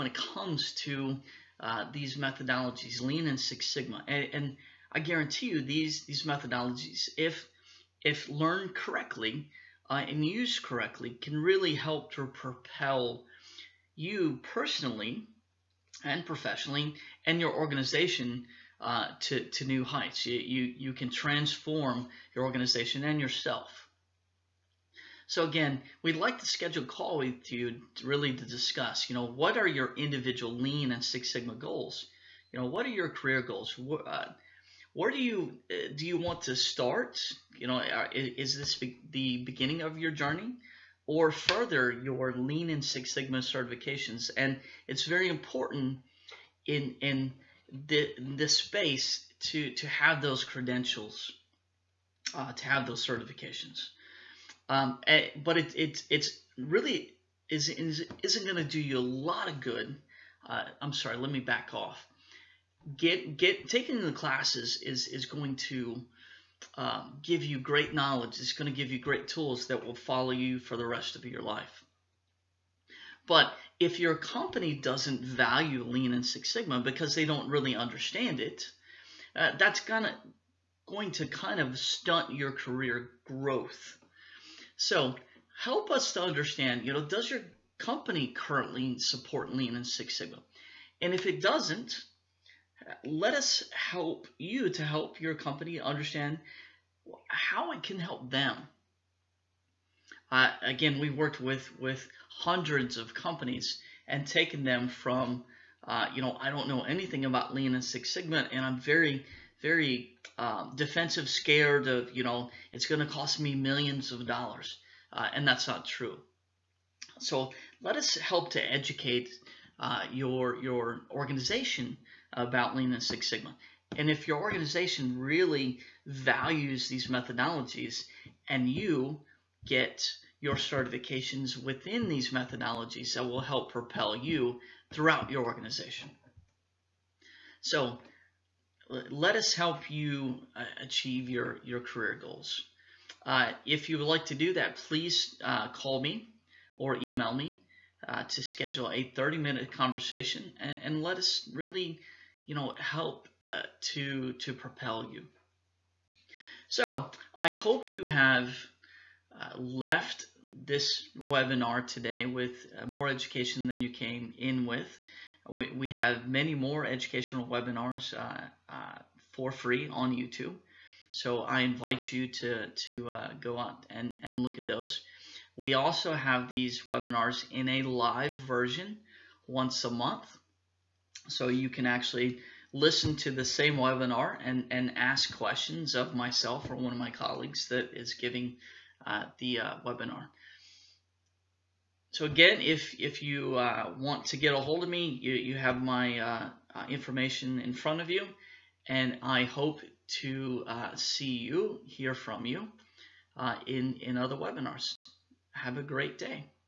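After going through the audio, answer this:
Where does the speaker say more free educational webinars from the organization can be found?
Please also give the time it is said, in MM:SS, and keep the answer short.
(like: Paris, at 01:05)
YouTube, at 02:50.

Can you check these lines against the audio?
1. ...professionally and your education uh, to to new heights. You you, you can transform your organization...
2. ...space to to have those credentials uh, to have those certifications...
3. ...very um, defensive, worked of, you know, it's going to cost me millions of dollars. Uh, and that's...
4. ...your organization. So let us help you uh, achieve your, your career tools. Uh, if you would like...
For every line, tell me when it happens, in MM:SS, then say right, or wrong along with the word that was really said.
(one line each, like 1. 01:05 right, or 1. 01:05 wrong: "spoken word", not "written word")
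1. 00:16 wrong: "organization", not "education"
2. 00:48 right
3. 01:49 wrong: "scared", not "worked"
4. 02:15 wrong: "goals", not "tools".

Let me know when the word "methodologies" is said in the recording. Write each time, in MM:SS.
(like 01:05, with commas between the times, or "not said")
00:02, 00:06, 02:07, 02:12.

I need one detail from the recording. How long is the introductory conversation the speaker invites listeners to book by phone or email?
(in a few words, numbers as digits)
30 minutes.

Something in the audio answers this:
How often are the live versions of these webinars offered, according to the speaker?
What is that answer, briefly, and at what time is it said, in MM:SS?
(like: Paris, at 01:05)
Once a month, at 02:59.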